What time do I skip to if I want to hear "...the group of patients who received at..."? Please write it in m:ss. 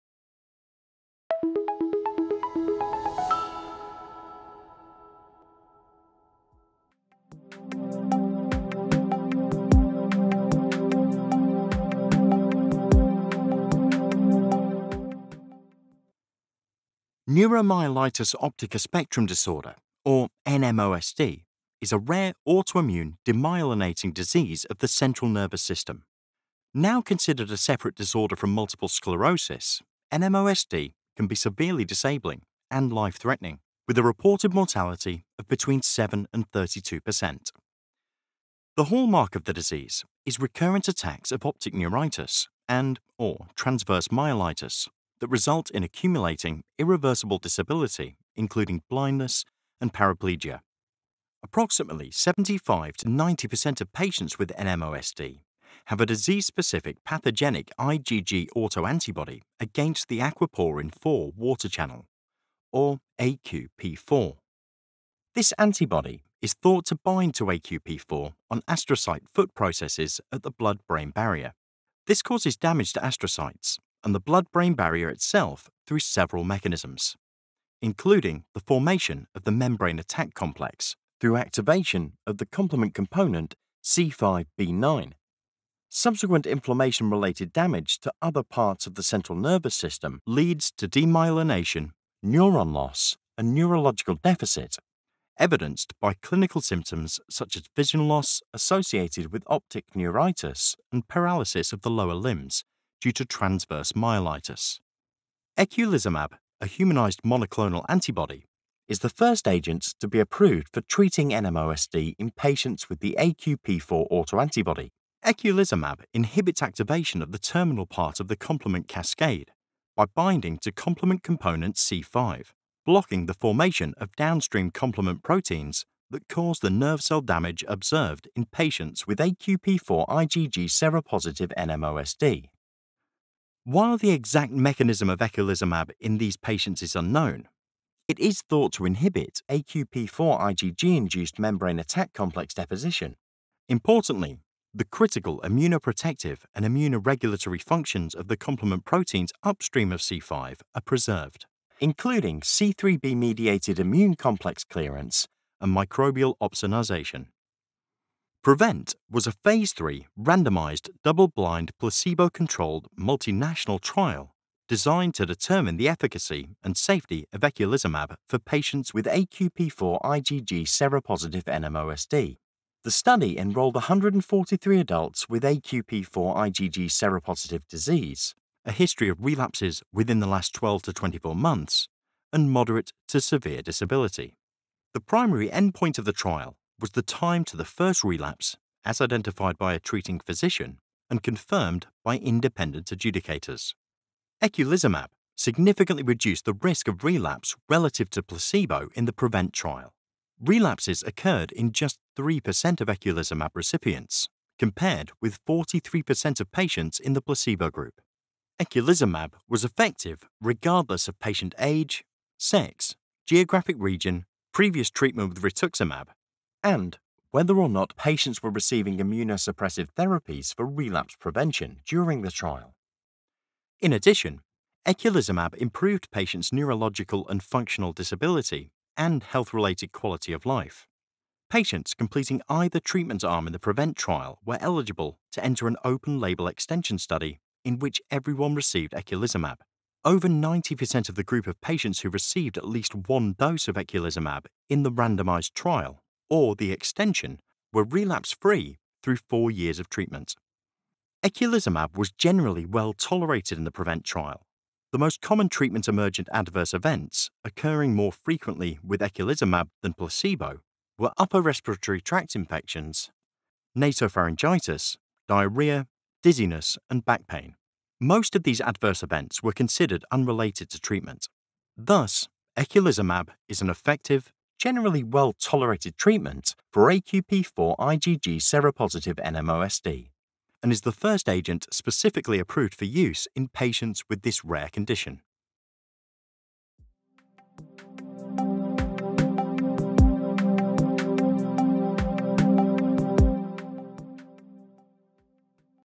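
4:01.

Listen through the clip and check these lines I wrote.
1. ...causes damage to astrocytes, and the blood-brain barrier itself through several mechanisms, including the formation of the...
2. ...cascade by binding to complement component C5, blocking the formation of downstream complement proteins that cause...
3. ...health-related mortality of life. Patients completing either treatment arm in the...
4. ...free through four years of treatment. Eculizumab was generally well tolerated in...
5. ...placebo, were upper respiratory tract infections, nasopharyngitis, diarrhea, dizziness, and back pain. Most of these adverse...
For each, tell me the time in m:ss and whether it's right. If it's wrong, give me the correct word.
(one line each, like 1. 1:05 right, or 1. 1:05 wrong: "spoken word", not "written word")
1. 1:12 right
2. 1:58 right
3. 3:49 wrong: "quality", not "mortality"
4. 4:08 right
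5. 4:19 right.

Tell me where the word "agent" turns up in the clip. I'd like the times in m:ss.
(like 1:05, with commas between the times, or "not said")
1:49, 4:41.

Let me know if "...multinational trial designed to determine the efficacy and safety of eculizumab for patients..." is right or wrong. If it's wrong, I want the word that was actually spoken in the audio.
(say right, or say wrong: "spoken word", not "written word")
right.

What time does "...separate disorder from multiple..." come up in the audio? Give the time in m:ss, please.
0:27.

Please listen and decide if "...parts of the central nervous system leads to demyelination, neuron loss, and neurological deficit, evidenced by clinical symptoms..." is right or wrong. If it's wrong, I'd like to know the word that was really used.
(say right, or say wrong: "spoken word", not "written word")
right.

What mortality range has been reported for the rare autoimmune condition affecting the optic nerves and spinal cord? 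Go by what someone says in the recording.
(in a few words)
7 to 32%.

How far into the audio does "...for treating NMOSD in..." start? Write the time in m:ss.
1:50.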